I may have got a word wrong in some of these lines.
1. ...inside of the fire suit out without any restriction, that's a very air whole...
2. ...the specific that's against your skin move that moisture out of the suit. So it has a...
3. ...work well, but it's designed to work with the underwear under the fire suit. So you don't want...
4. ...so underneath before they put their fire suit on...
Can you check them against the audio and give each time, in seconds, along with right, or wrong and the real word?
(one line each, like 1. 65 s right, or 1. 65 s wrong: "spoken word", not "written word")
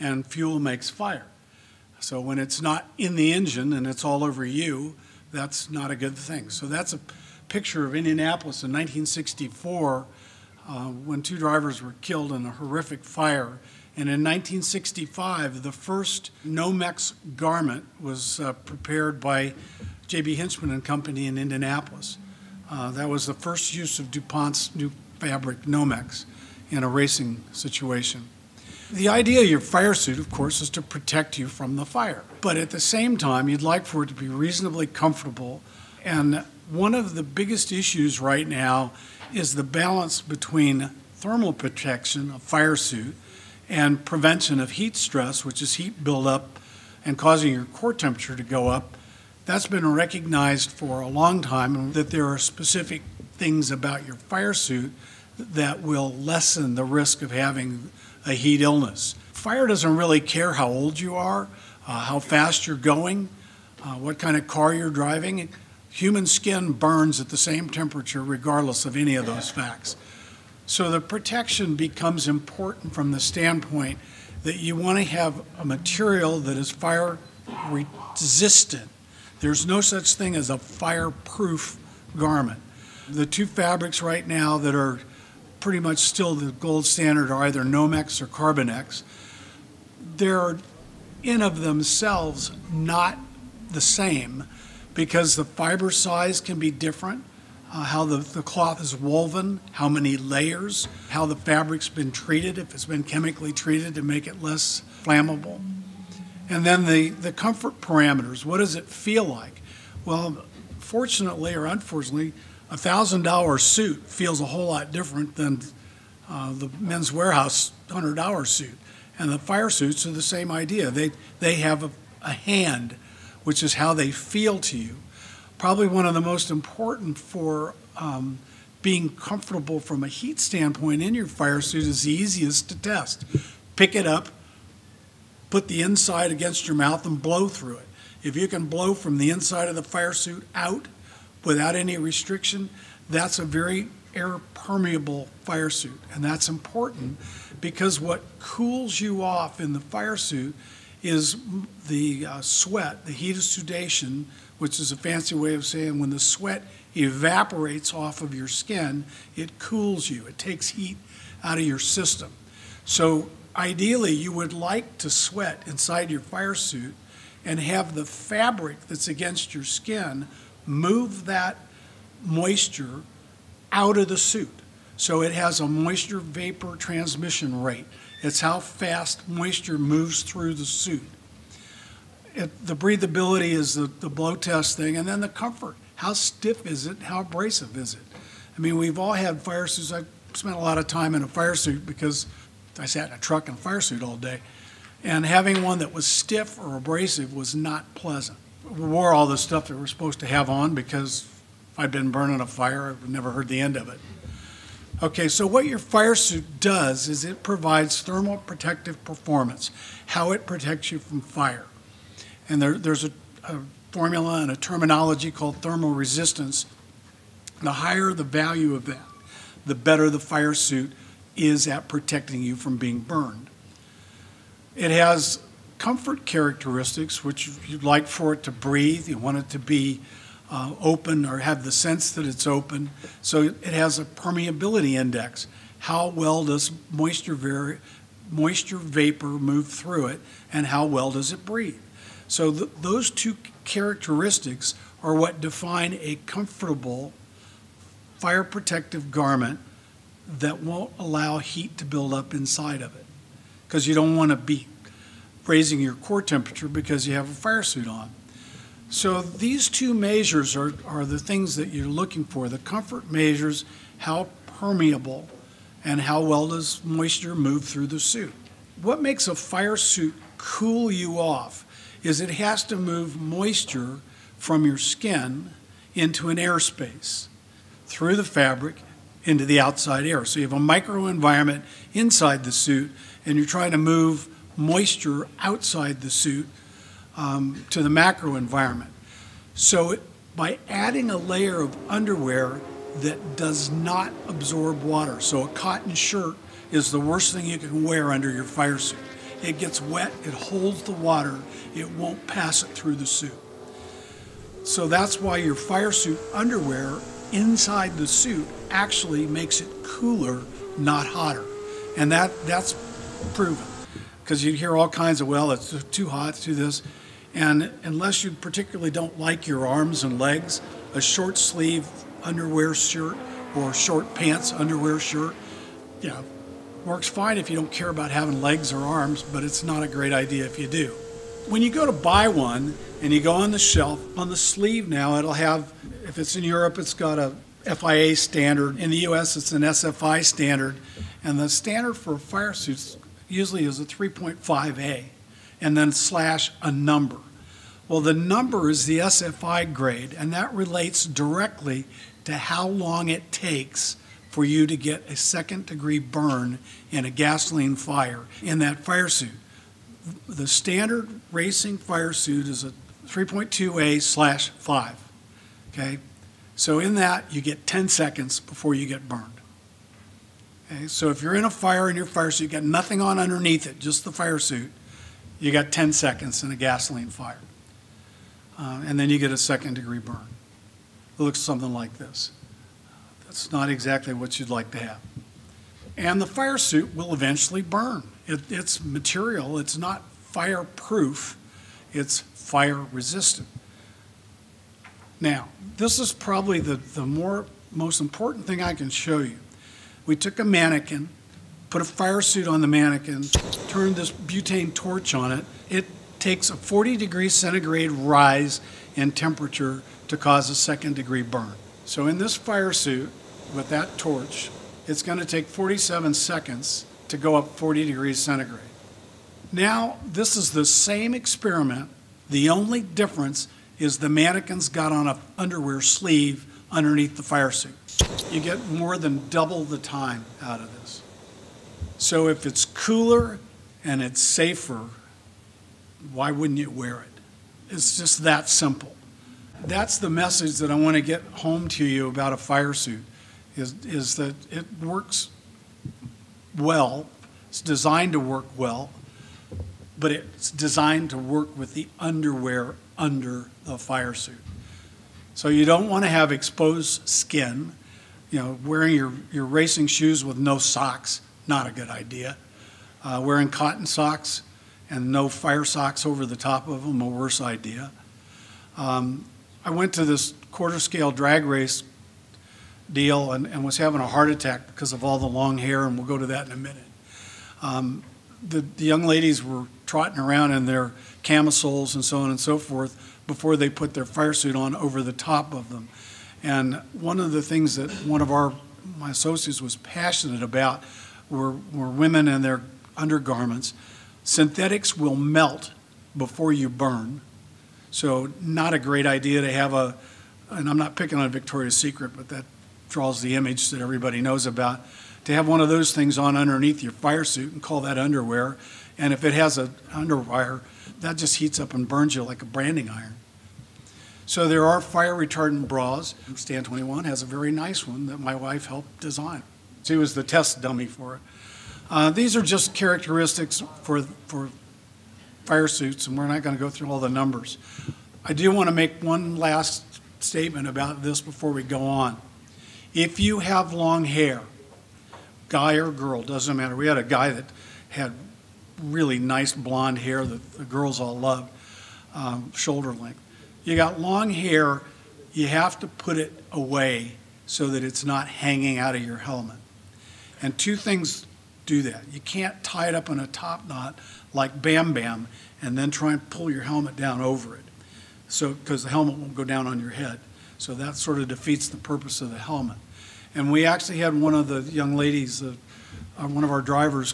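1. 139 s wrong: "permeable", not "whole"
2. 167 s wrong: "fabric", not "specific"
3. 448 s right
4. 482 s wrong: "forth", not "underneath".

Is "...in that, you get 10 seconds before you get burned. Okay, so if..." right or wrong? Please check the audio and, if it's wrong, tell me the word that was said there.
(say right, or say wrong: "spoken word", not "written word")
right.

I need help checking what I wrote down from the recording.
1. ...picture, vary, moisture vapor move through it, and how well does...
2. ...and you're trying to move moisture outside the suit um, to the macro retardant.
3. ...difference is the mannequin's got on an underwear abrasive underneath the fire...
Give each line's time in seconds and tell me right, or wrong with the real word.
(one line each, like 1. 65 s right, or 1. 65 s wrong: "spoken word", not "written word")
1. 236 s wrong: "moisture", not "picture"
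2. 283 s wrong: "environment", not "retardant"
3. 422 s wrong: "sleeve", not "abrasive".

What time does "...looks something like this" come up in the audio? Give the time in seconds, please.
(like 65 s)
381 s.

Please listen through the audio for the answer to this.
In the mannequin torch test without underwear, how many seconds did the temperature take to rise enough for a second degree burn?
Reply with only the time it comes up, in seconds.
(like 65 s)
415 s.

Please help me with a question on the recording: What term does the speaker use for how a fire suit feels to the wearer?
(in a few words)
hand.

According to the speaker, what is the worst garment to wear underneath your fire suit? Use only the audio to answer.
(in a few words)
cotton shirt.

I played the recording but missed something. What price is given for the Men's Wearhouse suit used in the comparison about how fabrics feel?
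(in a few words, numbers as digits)
$100.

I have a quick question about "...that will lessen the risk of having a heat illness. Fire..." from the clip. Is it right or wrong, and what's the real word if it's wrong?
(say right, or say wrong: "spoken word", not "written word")
right.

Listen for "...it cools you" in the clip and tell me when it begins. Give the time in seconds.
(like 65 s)
159 s.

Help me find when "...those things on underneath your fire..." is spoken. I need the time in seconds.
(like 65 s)
505 s.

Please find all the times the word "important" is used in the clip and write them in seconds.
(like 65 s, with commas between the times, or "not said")
72 s, 126 s, 146 s, 397 s.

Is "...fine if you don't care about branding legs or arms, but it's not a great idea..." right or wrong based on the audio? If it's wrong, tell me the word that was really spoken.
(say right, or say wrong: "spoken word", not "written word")
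wrong: "having", not "branding".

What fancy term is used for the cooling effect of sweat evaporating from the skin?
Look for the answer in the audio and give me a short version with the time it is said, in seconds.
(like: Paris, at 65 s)
heat of sudation, at 153 s.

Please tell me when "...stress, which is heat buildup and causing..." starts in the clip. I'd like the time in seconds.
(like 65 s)
44 s.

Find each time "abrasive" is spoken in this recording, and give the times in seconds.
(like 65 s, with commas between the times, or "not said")
187 s, 196 s.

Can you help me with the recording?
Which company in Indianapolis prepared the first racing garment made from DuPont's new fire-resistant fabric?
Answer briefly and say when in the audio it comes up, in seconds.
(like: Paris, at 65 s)
J.B. Hinchman and Company, at 20 s.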